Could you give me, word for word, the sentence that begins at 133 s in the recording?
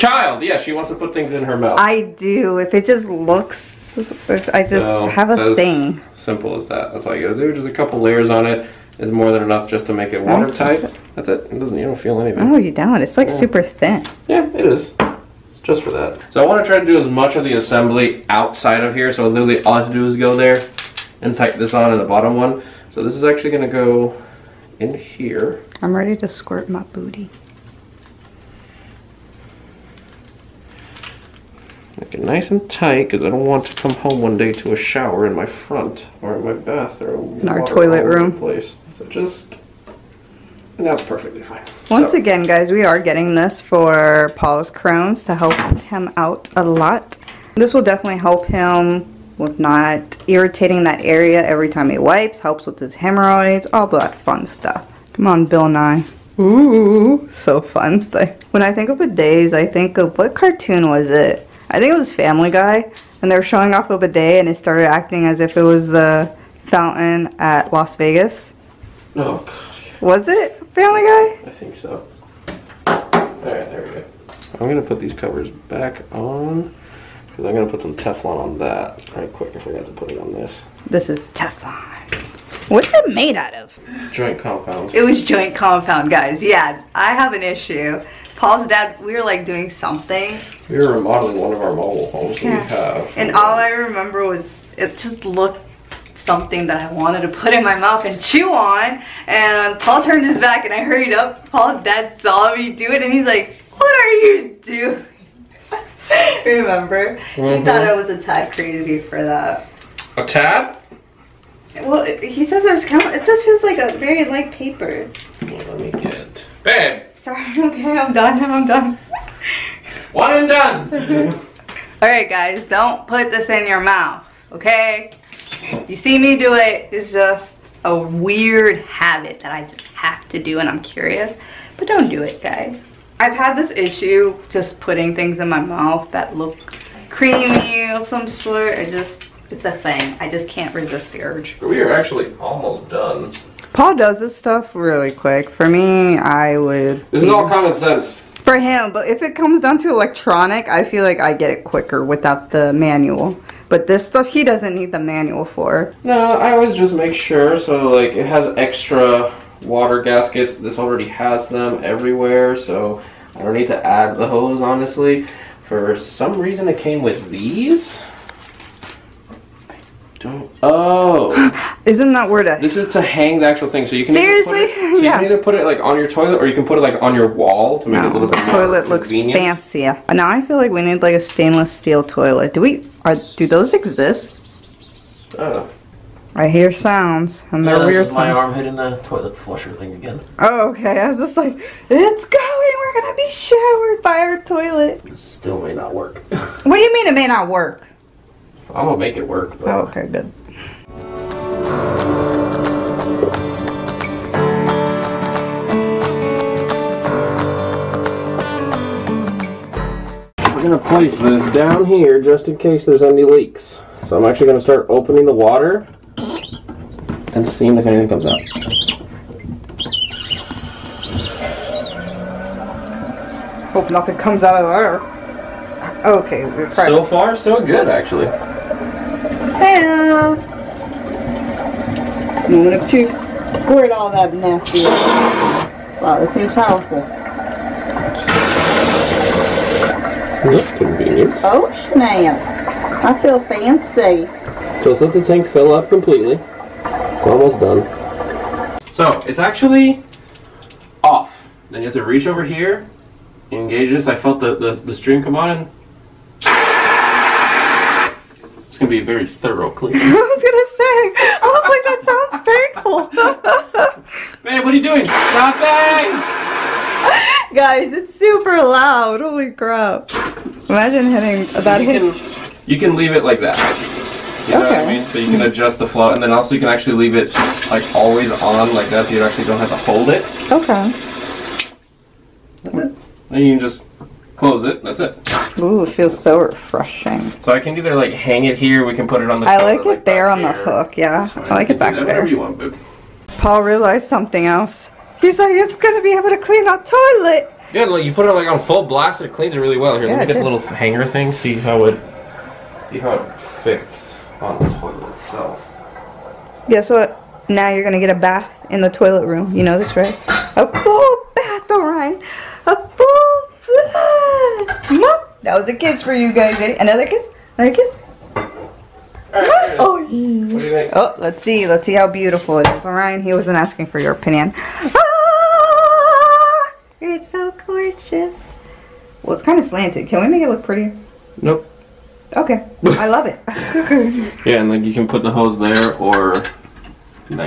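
I've had this issue just putting things in my mouth that look creamy of some sort.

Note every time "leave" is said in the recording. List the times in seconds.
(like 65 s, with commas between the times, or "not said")
272 s, 276 s.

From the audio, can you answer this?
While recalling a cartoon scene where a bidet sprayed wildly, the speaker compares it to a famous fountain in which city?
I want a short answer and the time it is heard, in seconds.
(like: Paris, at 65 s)
Las Vegas, at 67 s.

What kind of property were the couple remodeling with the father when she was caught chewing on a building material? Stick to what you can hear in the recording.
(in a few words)
Mobile homes.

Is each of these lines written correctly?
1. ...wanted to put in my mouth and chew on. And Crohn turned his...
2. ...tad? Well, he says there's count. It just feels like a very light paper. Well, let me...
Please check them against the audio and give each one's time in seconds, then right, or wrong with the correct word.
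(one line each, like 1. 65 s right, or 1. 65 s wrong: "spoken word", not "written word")
1. 96 s wrong: "Paul", not "Crohn"
2. 110 s right.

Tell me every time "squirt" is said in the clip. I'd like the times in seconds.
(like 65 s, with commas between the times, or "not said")
26 s, 233 s.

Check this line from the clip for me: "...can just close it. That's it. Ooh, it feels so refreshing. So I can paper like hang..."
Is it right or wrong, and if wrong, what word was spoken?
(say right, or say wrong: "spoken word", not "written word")
wrong: "either", not "paper".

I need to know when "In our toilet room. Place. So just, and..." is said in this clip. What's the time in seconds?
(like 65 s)
37 s.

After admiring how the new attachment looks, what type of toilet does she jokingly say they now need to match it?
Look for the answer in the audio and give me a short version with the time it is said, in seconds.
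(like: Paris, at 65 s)
Stainless steel, at 181 s.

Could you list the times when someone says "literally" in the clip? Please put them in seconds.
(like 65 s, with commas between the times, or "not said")
19 s.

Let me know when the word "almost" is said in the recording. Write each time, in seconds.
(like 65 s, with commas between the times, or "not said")
142 s, 247 s.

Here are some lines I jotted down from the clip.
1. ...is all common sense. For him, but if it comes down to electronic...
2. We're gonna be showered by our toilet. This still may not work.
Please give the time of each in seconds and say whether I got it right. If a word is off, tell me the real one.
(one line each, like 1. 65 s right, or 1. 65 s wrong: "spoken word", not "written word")
1. 147 s right
2. 192 s right.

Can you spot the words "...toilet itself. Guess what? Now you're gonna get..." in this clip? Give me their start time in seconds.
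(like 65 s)
304 s.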